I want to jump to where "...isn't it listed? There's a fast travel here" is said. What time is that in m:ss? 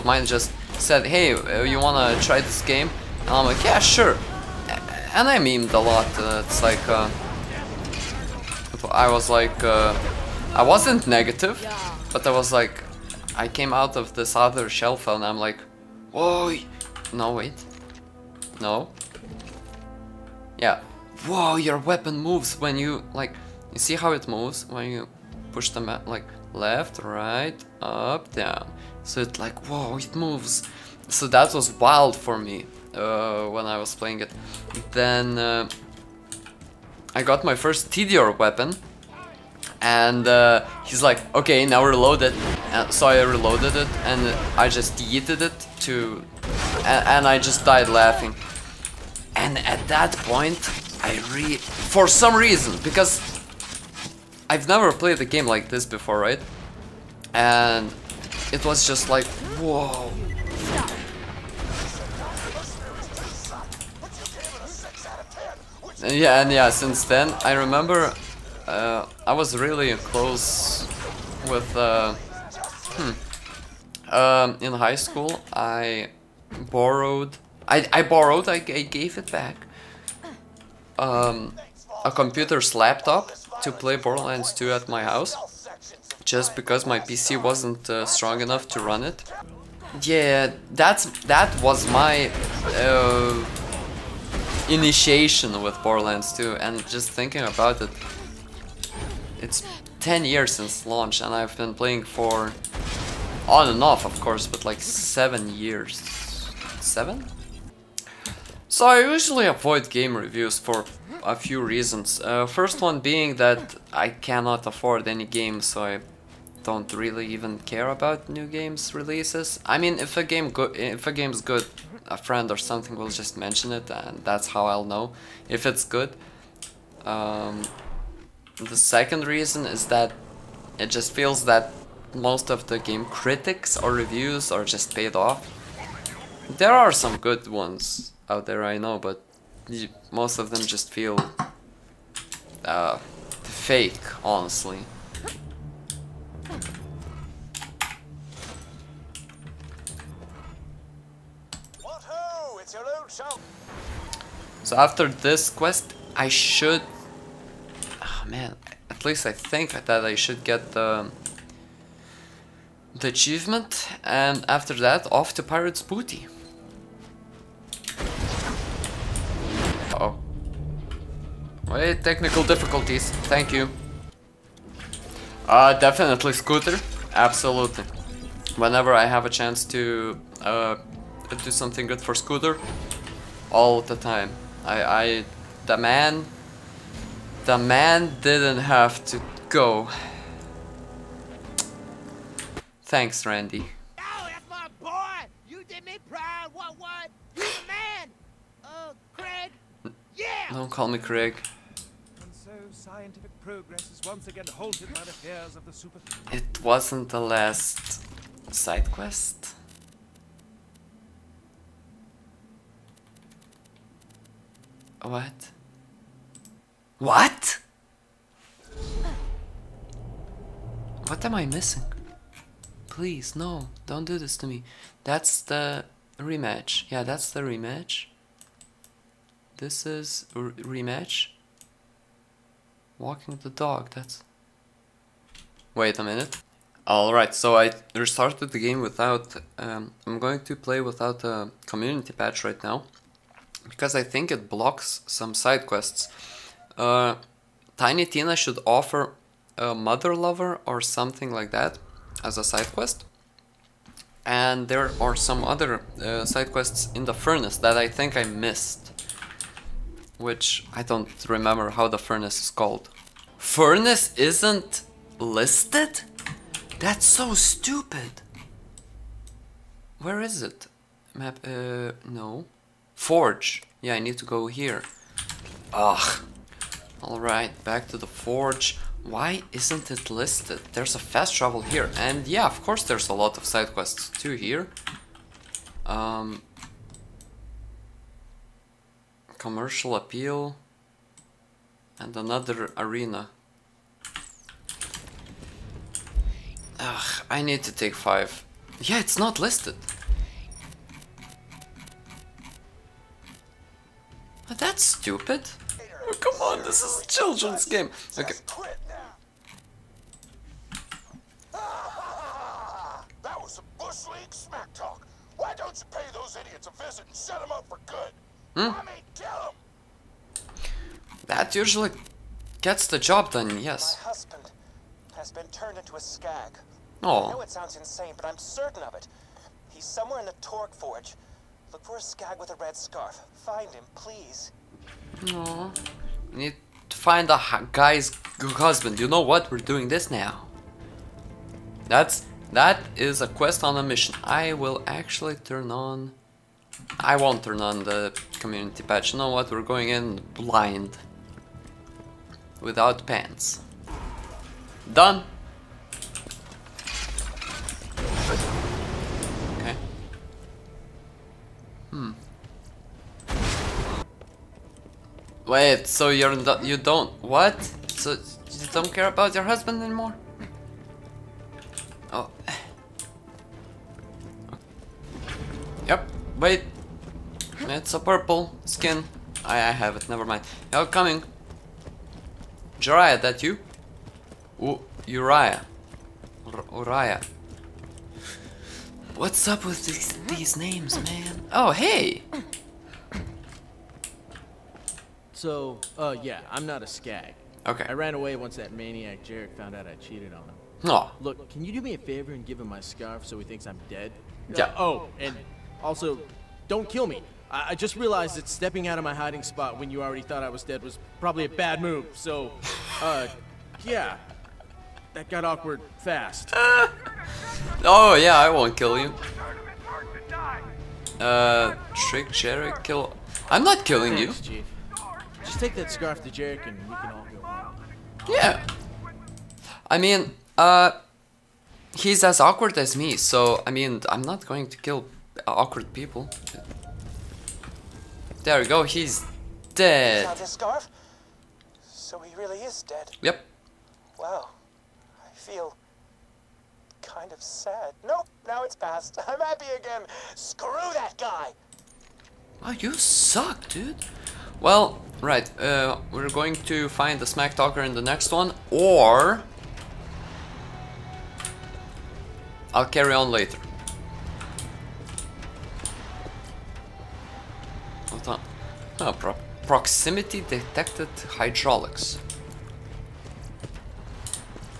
4:39.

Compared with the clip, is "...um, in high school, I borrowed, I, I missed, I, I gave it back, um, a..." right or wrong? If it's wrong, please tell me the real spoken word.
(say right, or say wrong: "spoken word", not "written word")
wrong: "borrowed", not "missed".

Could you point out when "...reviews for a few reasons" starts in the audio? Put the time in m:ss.
1:50.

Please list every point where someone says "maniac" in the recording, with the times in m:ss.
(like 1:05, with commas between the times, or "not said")
6:38.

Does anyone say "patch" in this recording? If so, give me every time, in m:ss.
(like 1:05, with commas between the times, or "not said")
4:02, 5:48.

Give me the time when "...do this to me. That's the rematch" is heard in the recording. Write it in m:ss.
3:44.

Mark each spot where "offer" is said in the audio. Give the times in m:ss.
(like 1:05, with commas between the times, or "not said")
4:08.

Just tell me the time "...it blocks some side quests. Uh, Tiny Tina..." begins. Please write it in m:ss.
4:04.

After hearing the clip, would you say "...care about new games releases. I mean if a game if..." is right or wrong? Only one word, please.
right.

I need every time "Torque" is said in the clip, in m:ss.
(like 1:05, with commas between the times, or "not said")
5:30.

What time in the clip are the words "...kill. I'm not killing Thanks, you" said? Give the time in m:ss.
7:02.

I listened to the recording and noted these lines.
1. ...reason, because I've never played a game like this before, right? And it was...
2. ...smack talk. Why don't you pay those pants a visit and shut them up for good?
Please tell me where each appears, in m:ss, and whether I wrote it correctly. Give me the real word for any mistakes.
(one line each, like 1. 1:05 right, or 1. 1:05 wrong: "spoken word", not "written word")
1. 0:52 right
2. 5:14 wrong: "idiots", not "pants".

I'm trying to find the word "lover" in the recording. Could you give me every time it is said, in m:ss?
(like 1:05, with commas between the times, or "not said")
4:10.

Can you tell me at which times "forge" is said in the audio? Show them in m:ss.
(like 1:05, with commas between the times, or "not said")
4:32, 4:38, 5:30.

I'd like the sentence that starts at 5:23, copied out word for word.
My husband has been turned into a skag.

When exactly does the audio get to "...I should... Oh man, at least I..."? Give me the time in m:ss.
2:36.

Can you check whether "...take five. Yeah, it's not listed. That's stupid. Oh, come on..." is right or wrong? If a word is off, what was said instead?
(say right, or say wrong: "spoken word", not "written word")
right.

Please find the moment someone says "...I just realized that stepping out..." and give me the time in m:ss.
6:47.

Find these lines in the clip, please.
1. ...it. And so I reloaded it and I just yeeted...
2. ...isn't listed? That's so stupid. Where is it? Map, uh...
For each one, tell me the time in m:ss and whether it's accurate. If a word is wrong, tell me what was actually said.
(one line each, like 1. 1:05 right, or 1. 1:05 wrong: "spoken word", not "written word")
1. 0:42 right
2. 4:24 right.